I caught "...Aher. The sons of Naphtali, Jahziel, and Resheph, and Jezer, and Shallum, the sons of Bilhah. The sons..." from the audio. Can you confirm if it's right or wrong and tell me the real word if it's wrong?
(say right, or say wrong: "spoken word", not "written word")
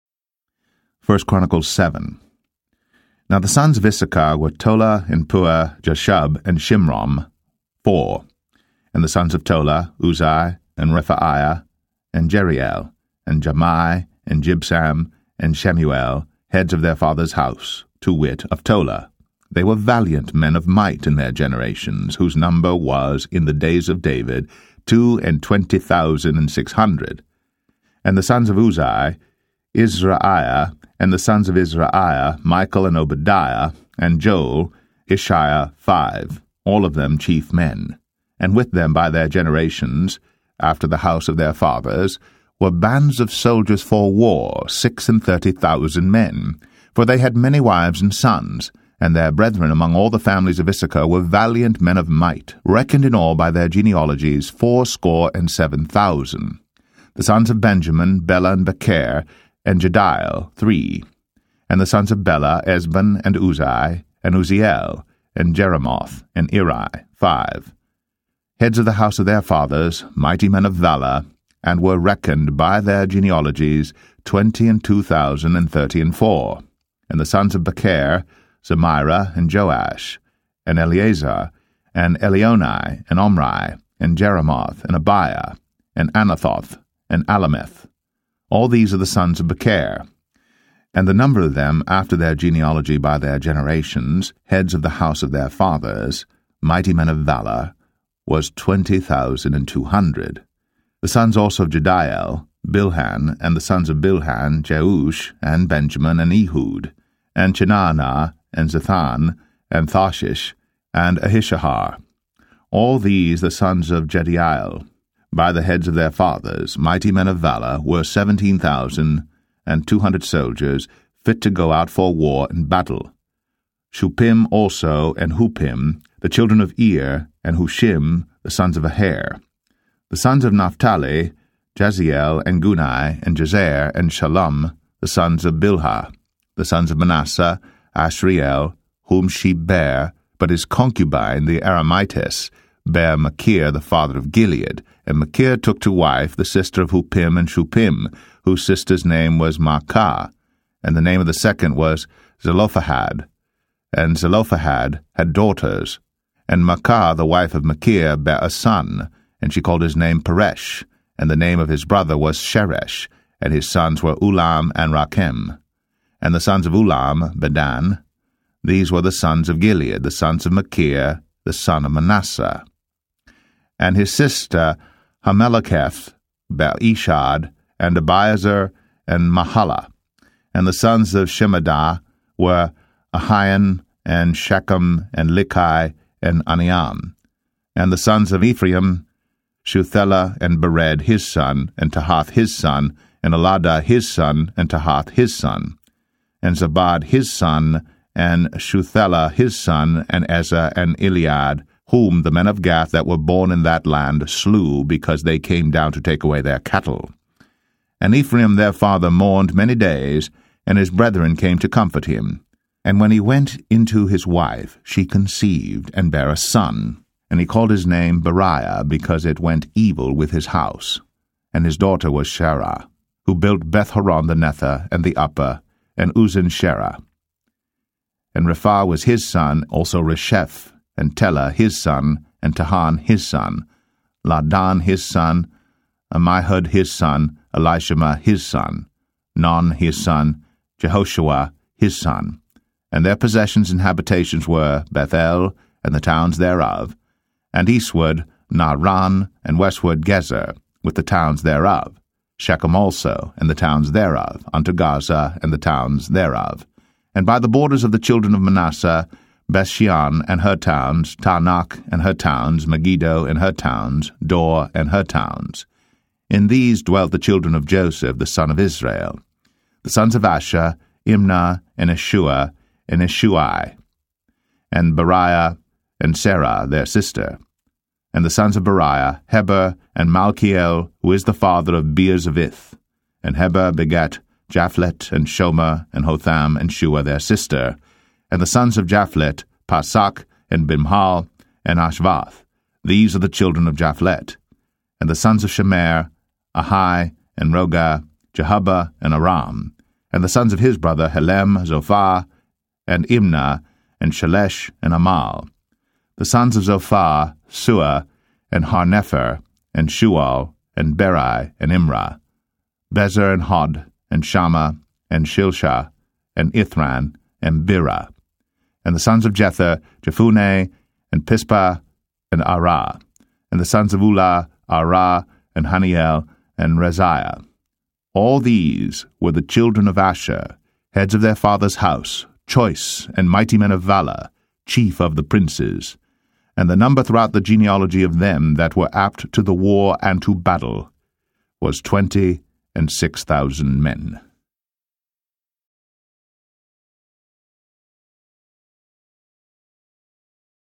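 wrong: "Guni", not "Resheph".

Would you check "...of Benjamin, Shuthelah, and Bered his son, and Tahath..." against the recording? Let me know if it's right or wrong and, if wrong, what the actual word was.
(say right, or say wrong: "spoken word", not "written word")
wrong: "Ephraim", not "Benjamin".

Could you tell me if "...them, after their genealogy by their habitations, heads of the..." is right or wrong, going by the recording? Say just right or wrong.
wrong.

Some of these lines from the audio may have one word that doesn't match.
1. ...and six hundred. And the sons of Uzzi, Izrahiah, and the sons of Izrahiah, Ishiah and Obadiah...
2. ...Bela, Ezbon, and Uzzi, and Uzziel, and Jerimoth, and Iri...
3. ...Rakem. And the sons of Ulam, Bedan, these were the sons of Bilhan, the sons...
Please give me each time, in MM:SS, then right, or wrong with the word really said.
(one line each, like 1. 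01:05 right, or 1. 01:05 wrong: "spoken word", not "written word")
1. 00:26 wrong: "Michael", not "Ishiah"
2. 01:02 right
3. 02:44 wrong: "Gilead", not "Bilhan".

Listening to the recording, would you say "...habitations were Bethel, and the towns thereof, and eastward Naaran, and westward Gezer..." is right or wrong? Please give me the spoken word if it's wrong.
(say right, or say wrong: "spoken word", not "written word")
right.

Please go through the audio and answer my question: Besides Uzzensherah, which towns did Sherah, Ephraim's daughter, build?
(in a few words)
Bethhoron the Nether and the Upper.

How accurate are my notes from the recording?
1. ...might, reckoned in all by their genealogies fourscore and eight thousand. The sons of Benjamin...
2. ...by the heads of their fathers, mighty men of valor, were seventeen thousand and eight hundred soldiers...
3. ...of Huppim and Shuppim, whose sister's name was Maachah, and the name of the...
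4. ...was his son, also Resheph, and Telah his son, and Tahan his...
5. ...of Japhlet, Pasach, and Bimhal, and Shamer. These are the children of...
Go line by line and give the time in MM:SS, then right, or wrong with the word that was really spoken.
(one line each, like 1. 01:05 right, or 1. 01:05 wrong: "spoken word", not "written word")
1. 00:52 wrong: "seven", not "eight"
2. 01:55 wrong: "two", not "eight"
3. 02:26 right
4. 03:48 right
5. 04:48 wrong: "Ashvath", not "Shamer".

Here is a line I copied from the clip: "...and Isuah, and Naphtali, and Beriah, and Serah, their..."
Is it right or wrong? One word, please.
wrong.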